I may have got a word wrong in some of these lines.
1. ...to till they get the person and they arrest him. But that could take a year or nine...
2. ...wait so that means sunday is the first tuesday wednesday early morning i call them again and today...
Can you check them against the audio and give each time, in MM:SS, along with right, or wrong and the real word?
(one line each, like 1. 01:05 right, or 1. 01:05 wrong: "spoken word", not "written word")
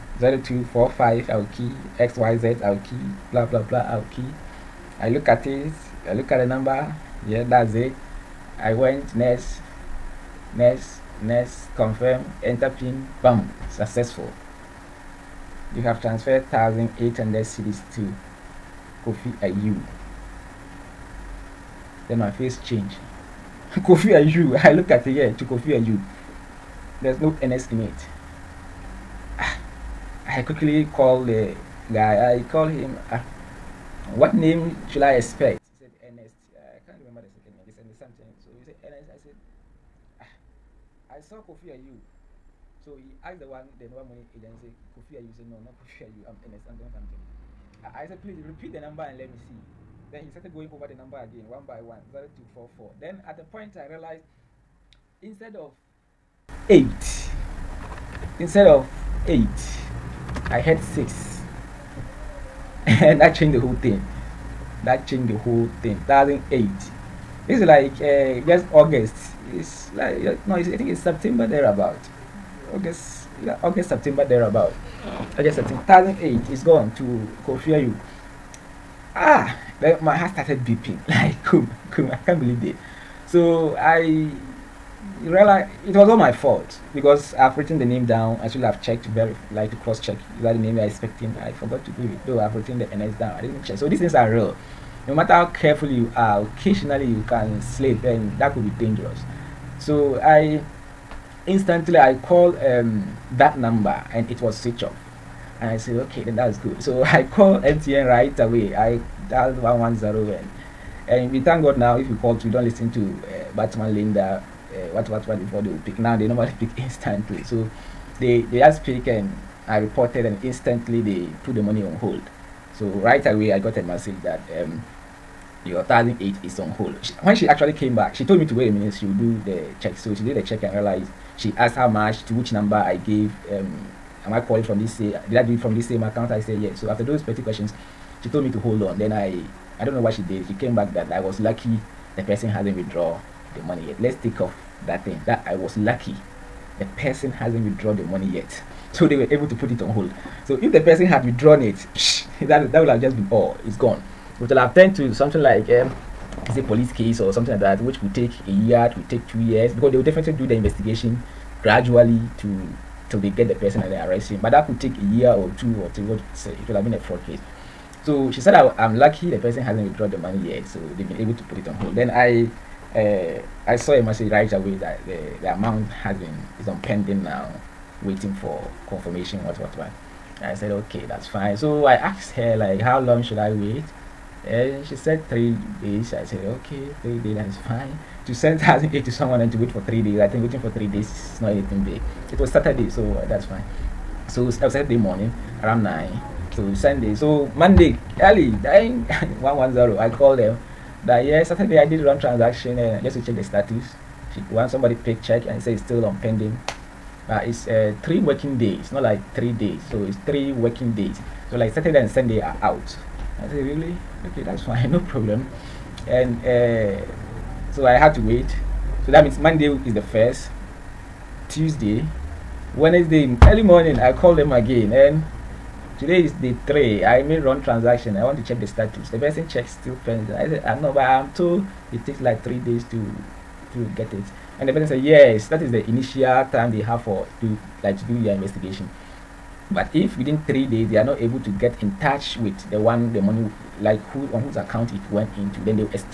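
1. 02:42 wrong: "two", not "nine"
2. 03:38 wrong: "monday", not "sunday".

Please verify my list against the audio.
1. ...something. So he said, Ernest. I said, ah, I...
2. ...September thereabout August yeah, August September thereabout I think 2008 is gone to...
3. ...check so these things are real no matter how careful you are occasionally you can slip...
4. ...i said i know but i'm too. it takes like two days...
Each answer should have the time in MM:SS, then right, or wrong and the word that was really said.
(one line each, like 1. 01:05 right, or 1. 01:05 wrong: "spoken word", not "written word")
1. 00:37 right
2. 01:10 right
3. 01:33 right
4. 03:50 wrong: "three", not "two".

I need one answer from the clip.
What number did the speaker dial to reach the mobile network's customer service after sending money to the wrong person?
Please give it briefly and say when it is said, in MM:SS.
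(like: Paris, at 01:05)
110, at 01:48.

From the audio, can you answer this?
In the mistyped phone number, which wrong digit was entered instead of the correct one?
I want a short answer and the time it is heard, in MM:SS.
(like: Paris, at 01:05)
6, at 01:00.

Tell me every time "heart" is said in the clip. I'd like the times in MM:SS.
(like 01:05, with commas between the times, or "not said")
01:20.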